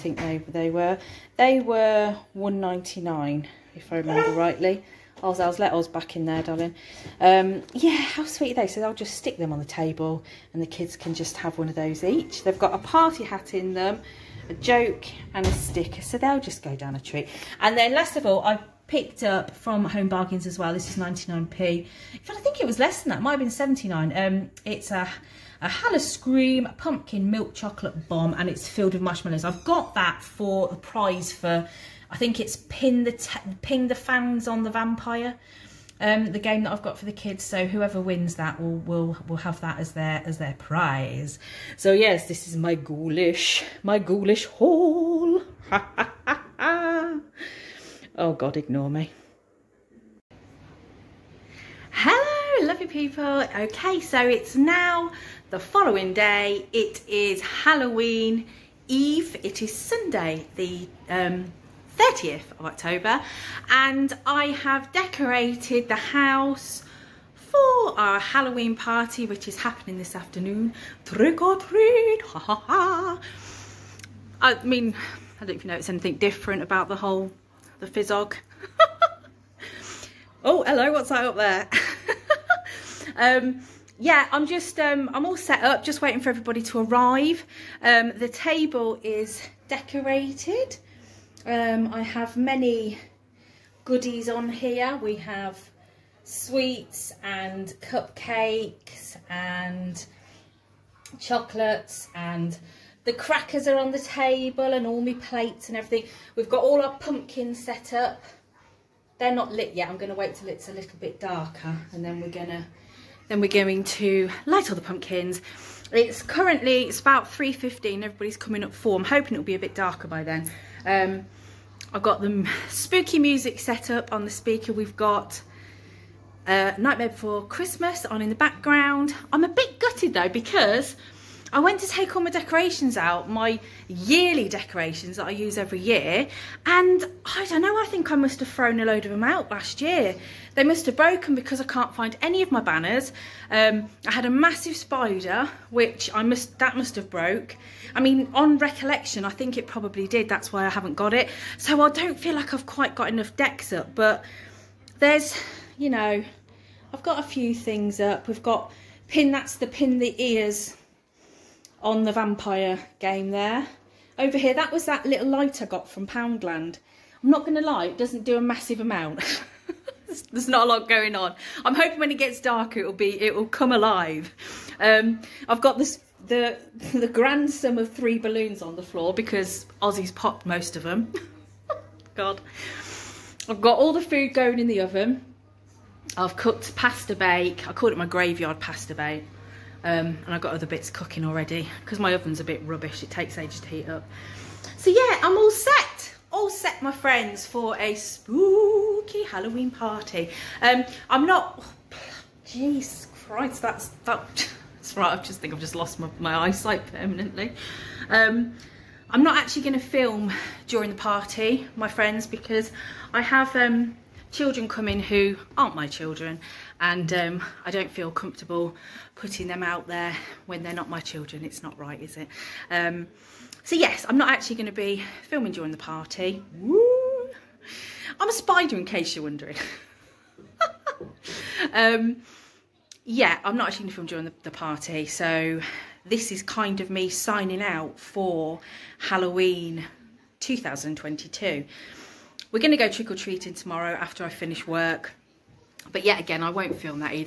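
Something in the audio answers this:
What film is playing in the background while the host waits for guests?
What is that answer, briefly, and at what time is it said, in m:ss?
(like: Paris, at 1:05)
Nightmare Before Christmas, at 2:06.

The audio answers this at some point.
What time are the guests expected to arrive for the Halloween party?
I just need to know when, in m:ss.
1:58.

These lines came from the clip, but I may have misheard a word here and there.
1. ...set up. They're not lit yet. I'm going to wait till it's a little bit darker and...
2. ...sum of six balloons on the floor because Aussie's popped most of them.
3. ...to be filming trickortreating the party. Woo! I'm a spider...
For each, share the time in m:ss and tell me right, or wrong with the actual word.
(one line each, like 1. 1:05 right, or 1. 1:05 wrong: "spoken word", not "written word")
1. 1:47 right
2. 2:57 wrong: "three", not "six"
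3. 3:44 wrong: "during", not "trickortreating".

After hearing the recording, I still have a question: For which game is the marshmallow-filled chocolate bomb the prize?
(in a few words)
Pin the fangs on the vampire.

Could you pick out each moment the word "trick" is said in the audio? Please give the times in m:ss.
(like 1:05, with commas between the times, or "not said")
1:11, 4:02.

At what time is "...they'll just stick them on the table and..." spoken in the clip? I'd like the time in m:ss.
0:08.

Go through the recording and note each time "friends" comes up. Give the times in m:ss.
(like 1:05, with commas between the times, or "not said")
3:16, 3:31.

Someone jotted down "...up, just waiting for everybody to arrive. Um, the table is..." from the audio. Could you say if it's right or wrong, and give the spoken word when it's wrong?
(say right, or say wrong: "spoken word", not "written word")
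right.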